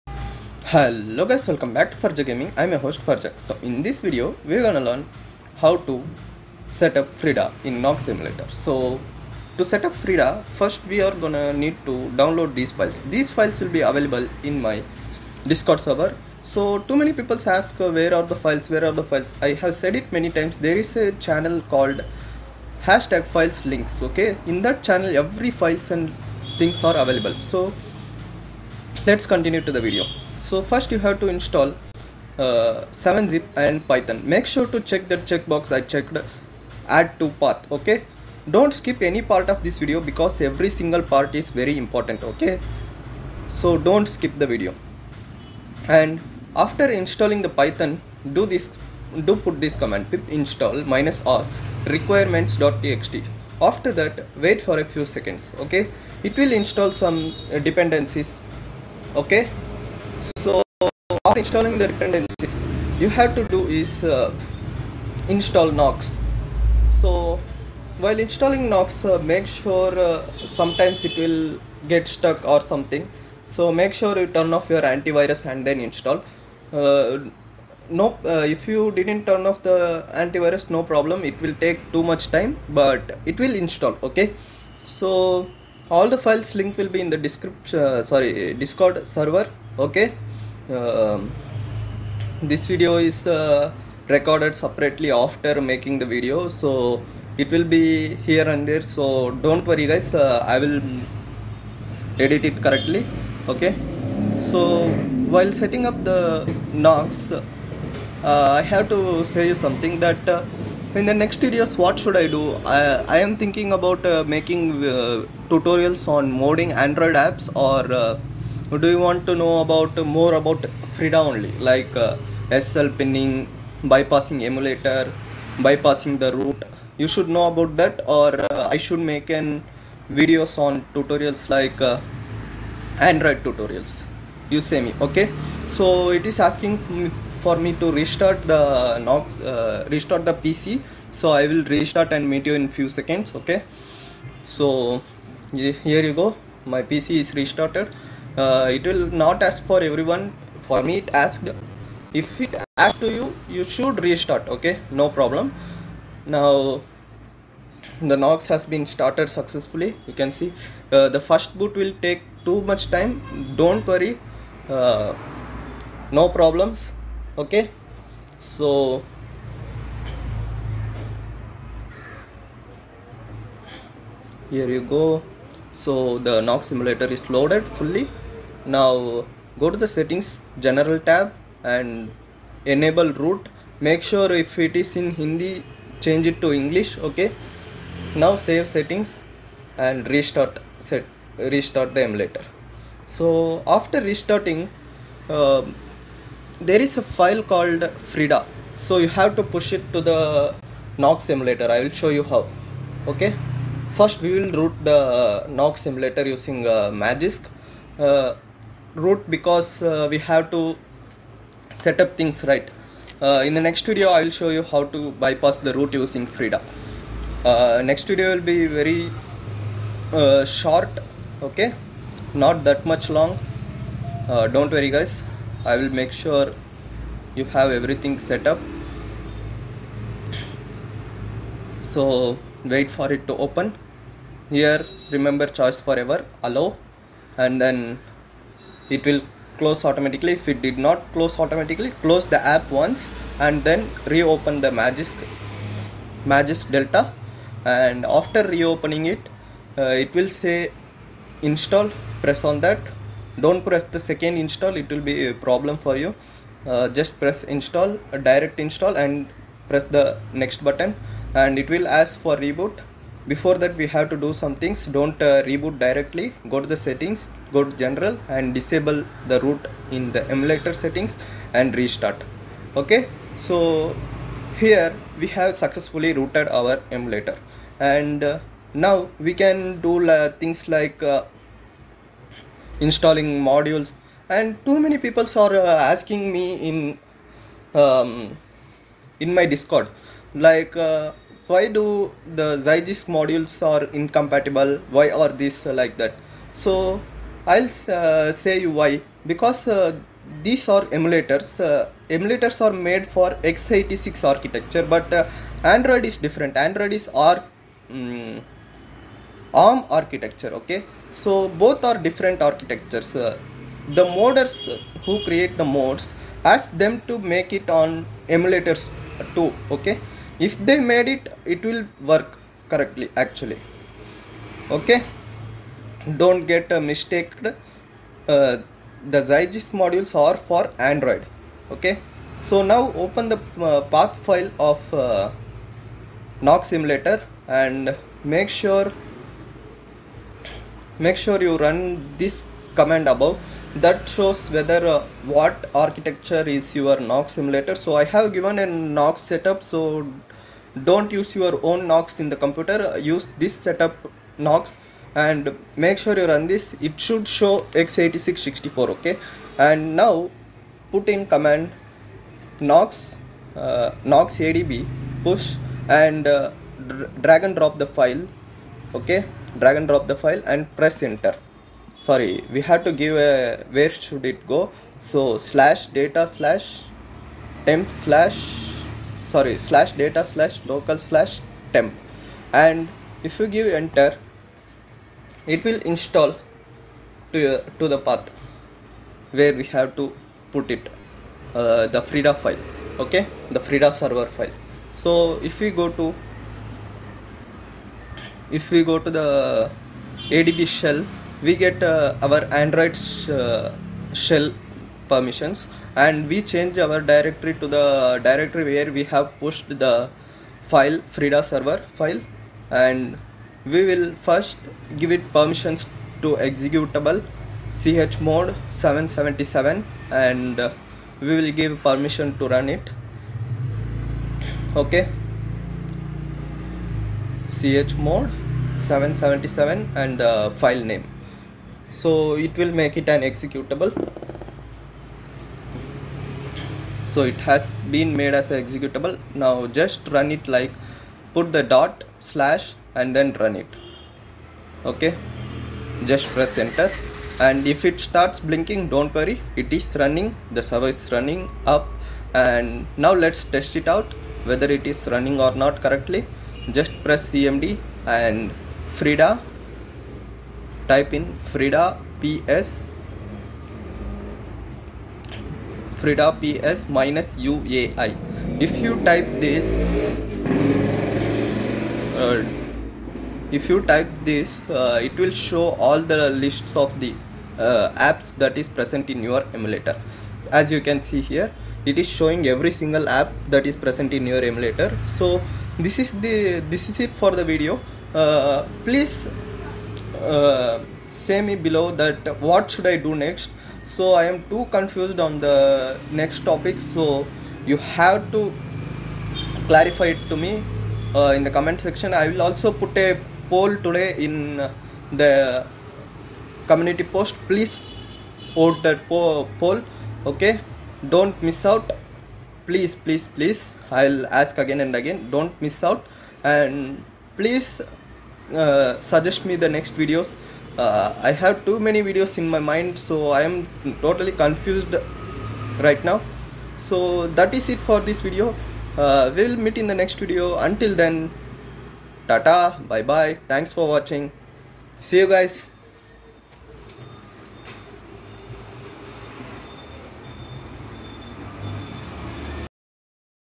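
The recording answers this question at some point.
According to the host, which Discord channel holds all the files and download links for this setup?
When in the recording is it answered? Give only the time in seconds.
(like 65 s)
22 s.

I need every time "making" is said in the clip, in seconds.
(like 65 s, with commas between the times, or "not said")
95 s, 114 s.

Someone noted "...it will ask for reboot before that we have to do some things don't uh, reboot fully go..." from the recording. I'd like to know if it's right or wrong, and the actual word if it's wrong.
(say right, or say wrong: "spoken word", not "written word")
wrong: "directly", not "fully".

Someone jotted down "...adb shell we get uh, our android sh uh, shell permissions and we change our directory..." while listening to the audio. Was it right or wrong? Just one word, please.
right.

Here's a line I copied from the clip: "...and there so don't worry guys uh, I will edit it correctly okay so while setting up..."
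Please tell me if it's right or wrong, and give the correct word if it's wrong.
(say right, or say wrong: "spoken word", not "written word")
right.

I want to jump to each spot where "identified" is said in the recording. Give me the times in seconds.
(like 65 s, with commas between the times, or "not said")
not said.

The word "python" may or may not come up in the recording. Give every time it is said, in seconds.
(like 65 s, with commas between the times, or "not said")
33 s, 47 s.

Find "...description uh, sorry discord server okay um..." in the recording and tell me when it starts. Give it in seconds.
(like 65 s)
87 s.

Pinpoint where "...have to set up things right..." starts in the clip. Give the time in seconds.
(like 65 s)
210 s.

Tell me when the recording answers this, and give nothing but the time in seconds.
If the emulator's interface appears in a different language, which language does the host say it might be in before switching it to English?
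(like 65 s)
185 s.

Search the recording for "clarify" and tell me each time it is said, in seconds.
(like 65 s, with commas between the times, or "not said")
499 s.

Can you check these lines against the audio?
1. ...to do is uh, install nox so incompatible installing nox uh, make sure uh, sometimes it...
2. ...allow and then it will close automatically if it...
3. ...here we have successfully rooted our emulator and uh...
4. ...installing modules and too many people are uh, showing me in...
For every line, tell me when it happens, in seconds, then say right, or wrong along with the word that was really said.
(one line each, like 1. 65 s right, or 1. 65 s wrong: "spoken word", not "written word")
1. 63 s wrong: "while", not "incompatible"
2. 236 s right
3. 274 s right
4. 282 s wrong: "asking", not "showing".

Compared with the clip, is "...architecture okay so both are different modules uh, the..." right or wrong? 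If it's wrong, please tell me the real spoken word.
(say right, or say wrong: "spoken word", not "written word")
wrong: "architectures", not "modules".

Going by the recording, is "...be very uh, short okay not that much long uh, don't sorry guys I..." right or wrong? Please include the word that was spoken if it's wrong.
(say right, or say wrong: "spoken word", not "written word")
wrong: "worry", not "sorry".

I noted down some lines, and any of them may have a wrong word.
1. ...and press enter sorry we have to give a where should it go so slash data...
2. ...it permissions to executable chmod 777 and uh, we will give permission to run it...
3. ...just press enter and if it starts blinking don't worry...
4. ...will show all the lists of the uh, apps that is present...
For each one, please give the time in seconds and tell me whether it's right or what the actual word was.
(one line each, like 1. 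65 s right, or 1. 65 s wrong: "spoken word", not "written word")
1. 370 s right
2. 415 s right
3. 446 s right
4. 475 s right.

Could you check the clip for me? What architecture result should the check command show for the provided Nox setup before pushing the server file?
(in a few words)
x86 64.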